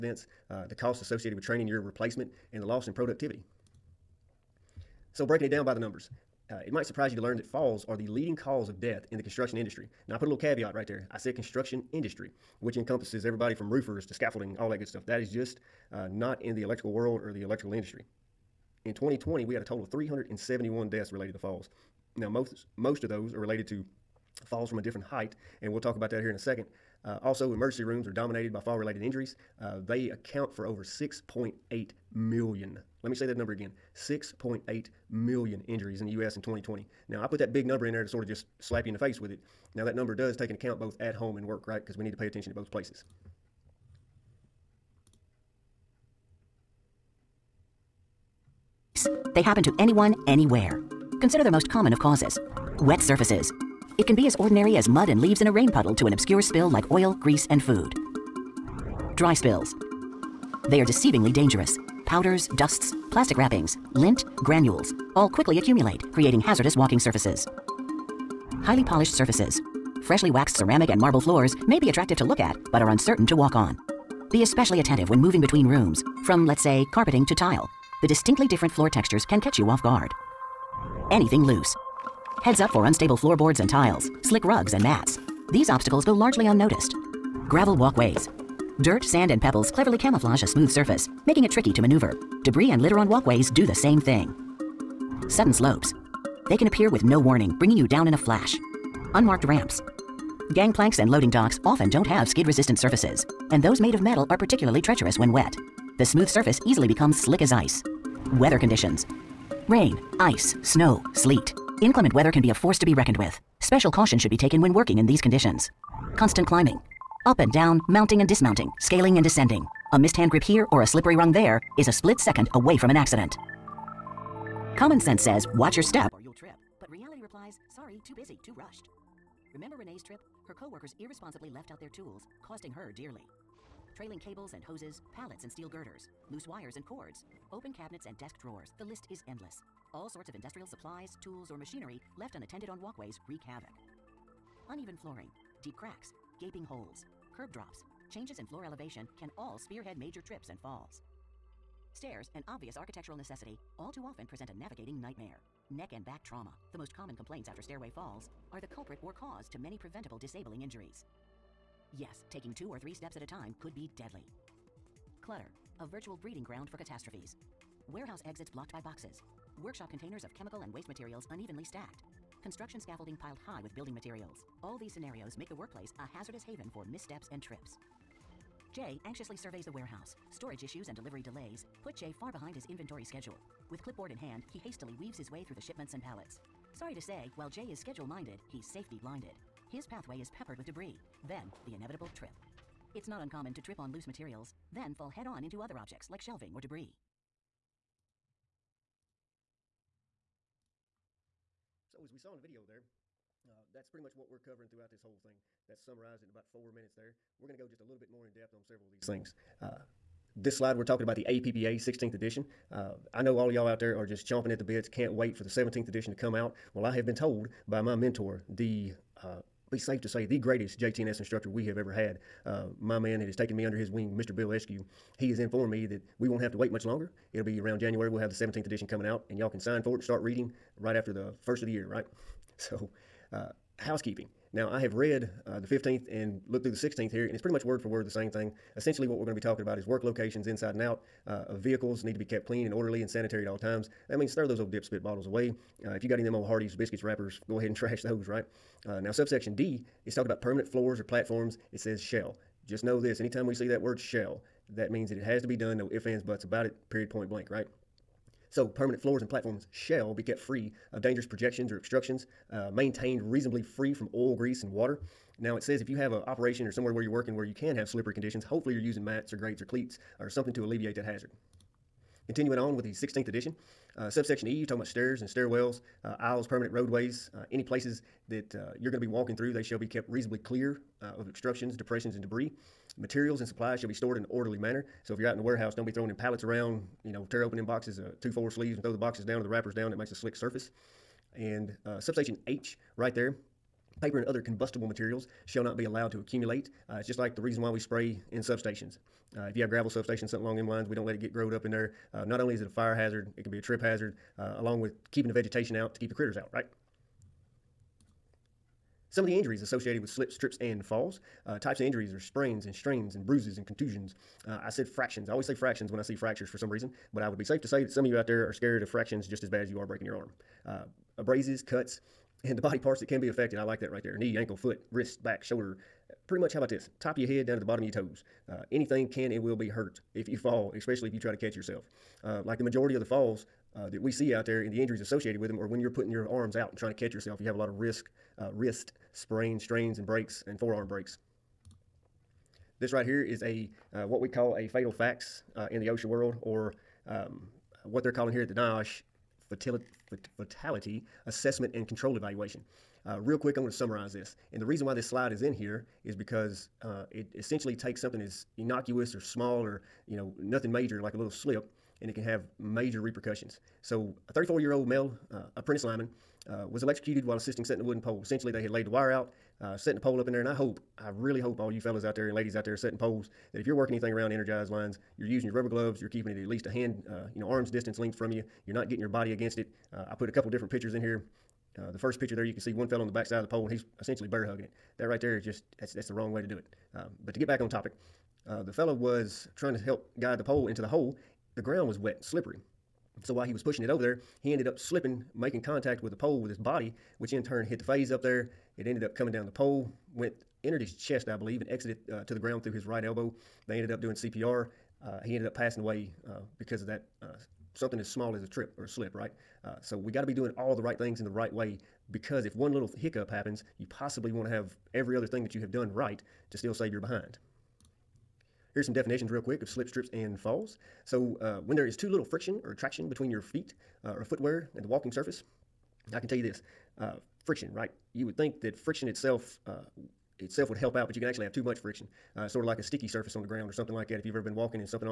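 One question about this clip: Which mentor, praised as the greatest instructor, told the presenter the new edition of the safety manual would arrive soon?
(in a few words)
Bill Eskew.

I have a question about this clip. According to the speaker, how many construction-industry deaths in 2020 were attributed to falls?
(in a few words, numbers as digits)
371.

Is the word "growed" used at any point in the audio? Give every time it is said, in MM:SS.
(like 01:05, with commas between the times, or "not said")
05:01.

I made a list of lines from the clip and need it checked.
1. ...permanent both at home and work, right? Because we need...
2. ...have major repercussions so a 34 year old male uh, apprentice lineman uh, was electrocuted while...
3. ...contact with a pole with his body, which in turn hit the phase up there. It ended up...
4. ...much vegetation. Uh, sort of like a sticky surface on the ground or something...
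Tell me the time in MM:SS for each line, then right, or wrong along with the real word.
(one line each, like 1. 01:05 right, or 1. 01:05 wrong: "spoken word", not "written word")
1. 00:40 wrong: "account", not "permanent"
2. 06:02 right
3. 06:35 right
4. 07:11 wrong: "friction", not "vegetation".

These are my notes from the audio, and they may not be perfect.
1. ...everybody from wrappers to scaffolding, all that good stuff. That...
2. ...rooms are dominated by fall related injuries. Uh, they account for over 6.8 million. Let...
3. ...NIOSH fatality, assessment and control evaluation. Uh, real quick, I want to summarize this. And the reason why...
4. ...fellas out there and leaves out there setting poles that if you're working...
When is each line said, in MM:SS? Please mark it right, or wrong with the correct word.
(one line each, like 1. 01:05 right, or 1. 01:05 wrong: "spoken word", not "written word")
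1. 00:13 wrong: "roofers", not "wrappers"
2. 00:27 right
3. 05:48 right
4. 06:11 wrong: "ladies", not "leaves".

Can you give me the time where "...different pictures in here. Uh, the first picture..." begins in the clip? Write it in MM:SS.
06:20.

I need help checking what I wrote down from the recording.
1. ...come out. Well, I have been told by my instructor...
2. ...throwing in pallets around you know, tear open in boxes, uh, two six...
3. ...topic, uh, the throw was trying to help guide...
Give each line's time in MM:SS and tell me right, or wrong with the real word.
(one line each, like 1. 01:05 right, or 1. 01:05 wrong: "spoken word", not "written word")
1. 03:36 wrong: "mentor", not "instructor"
2. 04:45 wrong: "four", not "six"
3. 06:27 wrong: "fellow", not "throw".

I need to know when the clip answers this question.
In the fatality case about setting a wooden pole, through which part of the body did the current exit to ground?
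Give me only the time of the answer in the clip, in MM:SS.
06:42.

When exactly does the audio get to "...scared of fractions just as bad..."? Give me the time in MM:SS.
05:18.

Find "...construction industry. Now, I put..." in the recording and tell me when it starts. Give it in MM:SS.
00:09.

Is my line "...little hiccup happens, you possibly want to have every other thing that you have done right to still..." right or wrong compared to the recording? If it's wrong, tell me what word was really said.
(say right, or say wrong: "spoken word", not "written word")
right.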